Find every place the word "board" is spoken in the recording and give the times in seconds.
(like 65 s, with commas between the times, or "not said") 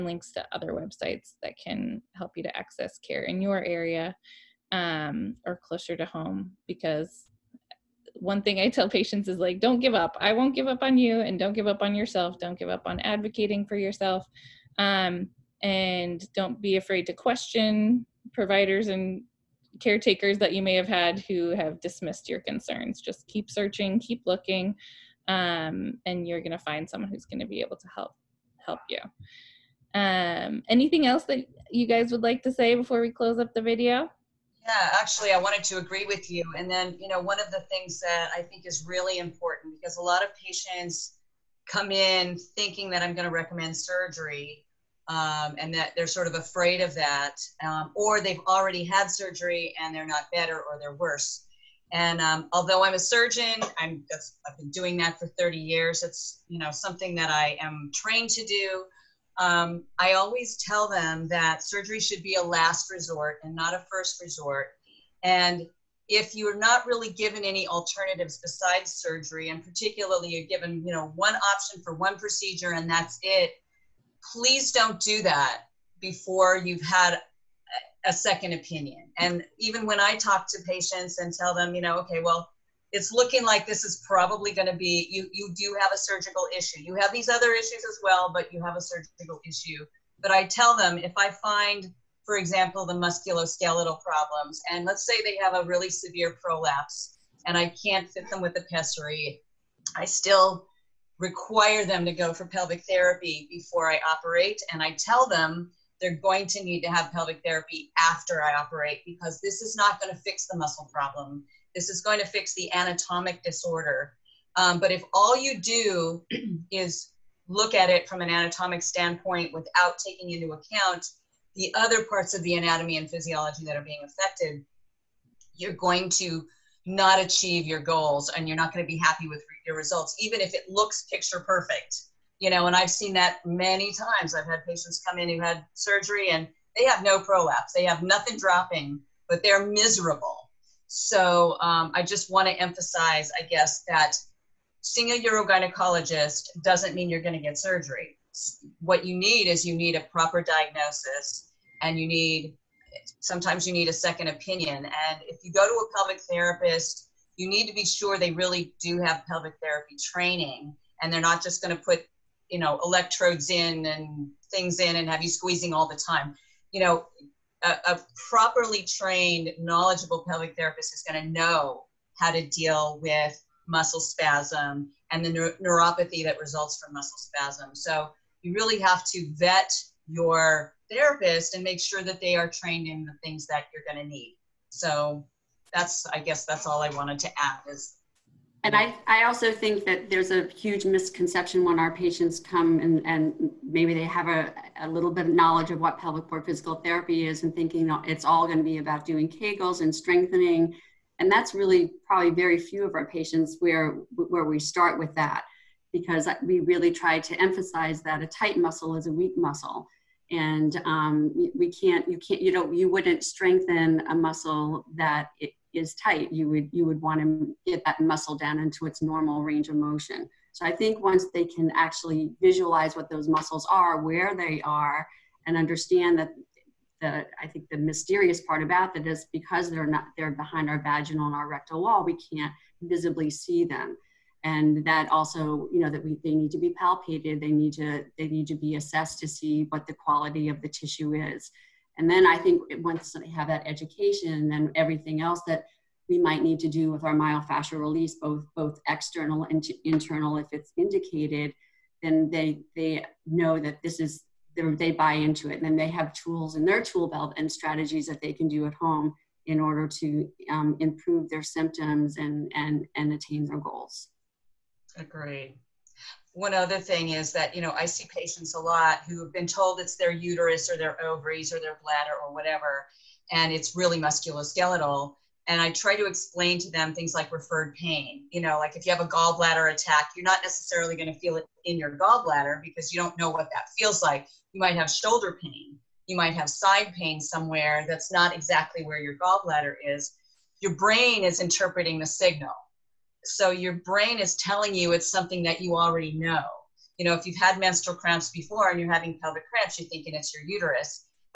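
196 s.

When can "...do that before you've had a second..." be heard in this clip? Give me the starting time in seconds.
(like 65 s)
74 s.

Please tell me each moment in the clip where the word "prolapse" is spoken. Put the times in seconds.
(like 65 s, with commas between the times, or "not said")
96 s, 137 s.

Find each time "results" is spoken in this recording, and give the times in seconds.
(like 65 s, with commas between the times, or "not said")
129 s, 176 s.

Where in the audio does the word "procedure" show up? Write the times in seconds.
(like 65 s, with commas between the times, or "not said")
72 s.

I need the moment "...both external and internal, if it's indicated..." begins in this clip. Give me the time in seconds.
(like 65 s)
248 s.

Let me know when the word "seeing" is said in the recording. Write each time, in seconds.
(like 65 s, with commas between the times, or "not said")
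144 s.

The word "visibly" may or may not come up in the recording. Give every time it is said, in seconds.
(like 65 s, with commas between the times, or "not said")
232 s.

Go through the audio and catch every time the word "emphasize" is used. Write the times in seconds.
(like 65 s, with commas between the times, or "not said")
142 s, 207 s.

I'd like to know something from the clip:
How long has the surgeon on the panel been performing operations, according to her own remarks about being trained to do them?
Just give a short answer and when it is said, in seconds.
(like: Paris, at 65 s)
30 years, at 55 s.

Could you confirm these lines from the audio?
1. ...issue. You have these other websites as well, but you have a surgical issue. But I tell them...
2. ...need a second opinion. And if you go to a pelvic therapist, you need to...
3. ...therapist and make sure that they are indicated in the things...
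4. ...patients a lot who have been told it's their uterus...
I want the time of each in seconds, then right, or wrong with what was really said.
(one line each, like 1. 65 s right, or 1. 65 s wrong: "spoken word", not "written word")
1. 86 s wrong: "issues", not "websites"
2. 153 s right
3. 180 s wrong: "trained", not "indicated"
4. 268 s right.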